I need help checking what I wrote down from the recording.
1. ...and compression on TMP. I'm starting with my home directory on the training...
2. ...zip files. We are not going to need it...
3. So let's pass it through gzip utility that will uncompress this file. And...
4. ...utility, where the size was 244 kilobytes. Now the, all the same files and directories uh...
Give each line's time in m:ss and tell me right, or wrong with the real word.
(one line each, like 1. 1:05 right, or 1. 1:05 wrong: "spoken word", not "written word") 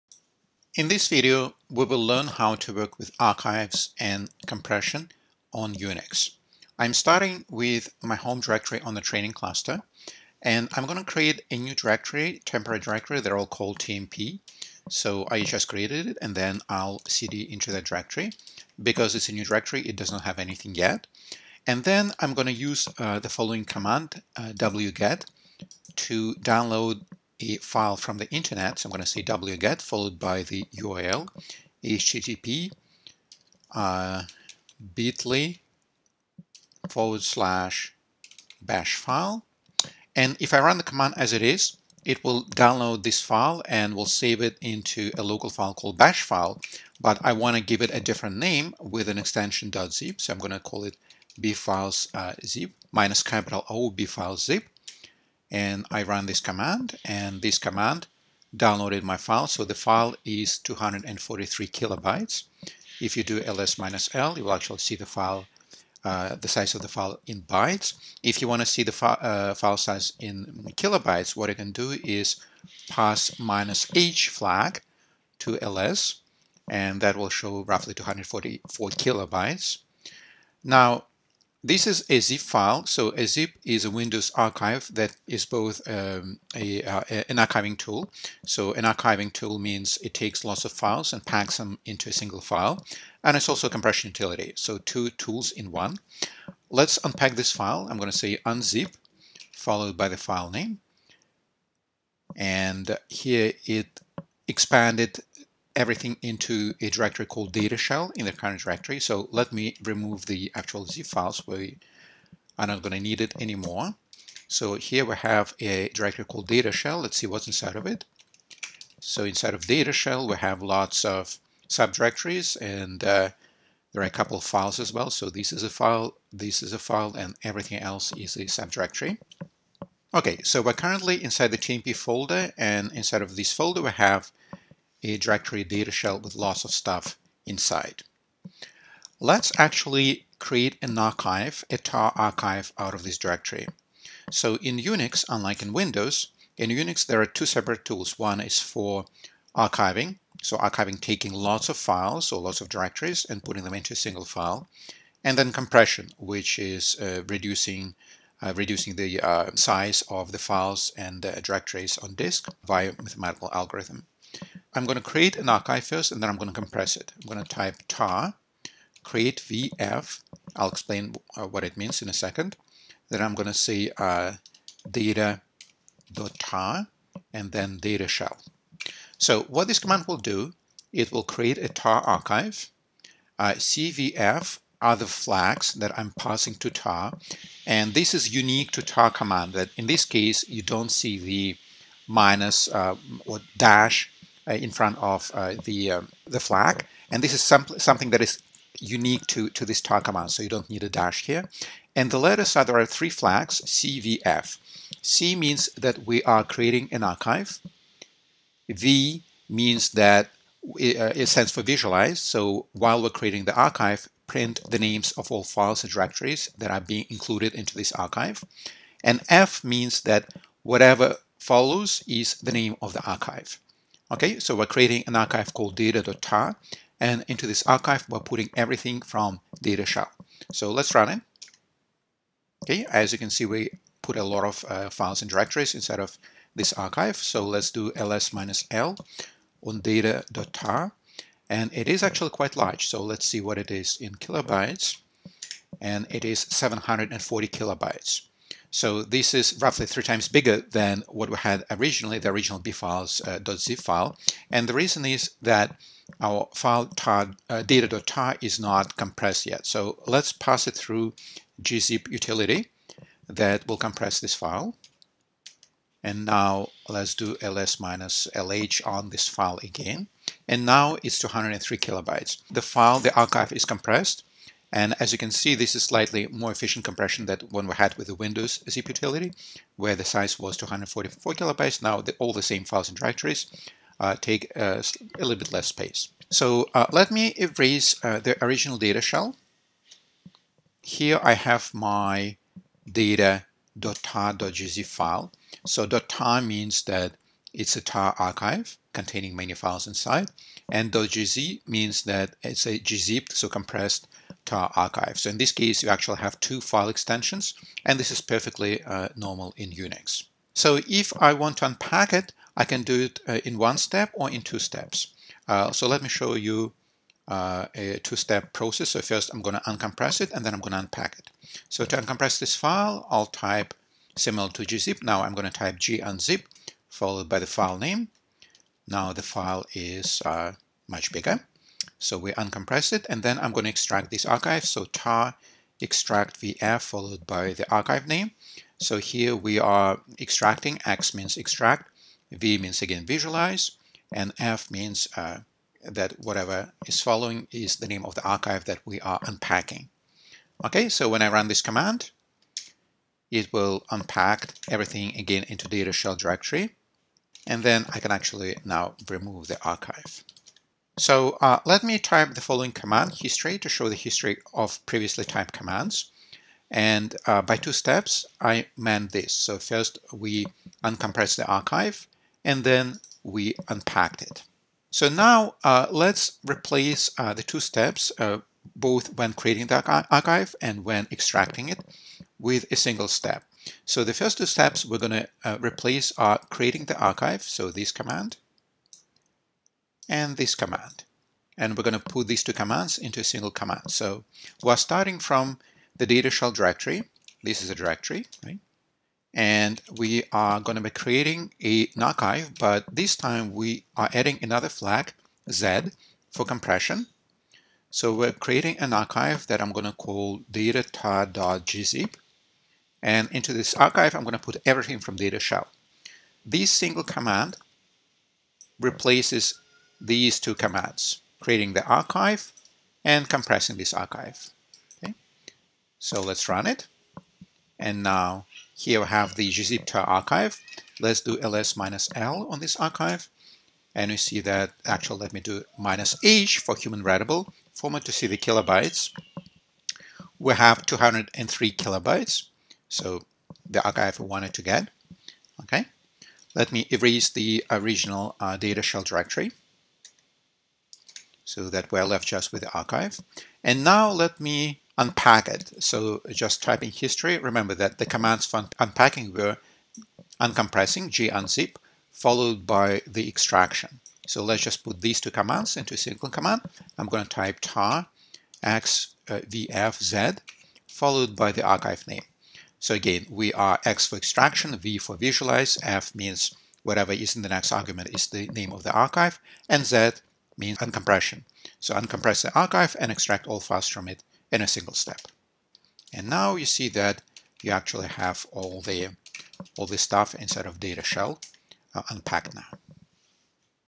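1. 0:03 wrong: "Unix", not "TMP"
2. 1:50 right
3. 4:19 wrong: "compress", not "uncompress"
4. 4:38 right.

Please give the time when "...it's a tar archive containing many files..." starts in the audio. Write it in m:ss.
4:57.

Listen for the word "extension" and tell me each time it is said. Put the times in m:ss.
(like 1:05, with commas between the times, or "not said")
0:49, 5:06.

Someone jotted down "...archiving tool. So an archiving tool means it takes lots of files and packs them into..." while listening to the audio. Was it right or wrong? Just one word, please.
right.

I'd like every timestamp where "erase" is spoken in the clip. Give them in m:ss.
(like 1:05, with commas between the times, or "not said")
4:47, 7:26.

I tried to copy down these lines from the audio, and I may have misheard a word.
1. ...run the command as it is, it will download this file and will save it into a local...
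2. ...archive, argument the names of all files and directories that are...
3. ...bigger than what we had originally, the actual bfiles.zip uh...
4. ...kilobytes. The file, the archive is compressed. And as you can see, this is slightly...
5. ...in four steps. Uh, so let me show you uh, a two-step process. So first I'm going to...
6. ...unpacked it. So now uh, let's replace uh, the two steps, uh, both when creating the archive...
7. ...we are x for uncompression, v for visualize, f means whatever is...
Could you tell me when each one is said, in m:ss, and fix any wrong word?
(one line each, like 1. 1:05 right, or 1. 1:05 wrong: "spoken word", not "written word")
1. 0:40 right
2. 3:33 wrong: "print", not "argument"
3. 4:10 wrong: "original", not "actual"
4. 4:31 right
5. 5:14 wrong: "two", not "four"
6. 6:13 right
7. 7:53 wrong: "extraction", not "uncompression".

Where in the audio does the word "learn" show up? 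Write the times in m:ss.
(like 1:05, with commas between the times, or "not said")
0:02.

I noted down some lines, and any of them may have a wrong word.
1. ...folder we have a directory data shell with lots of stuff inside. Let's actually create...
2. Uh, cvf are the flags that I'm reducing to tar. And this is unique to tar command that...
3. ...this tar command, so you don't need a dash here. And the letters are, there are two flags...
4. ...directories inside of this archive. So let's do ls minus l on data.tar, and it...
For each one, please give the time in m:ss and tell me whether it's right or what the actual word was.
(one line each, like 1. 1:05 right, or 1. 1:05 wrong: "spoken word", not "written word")
1. 2:13 right
2. 3:03 wrong: "passing", not "reducing"
3. 3:19 wrong: "three", not "two"
4. 3:55 right.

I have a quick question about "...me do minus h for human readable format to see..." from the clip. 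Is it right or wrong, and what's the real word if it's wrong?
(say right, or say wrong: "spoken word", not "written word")
right.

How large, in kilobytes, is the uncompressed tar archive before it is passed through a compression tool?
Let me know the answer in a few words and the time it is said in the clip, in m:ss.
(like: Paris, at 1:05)
740, at 4:06.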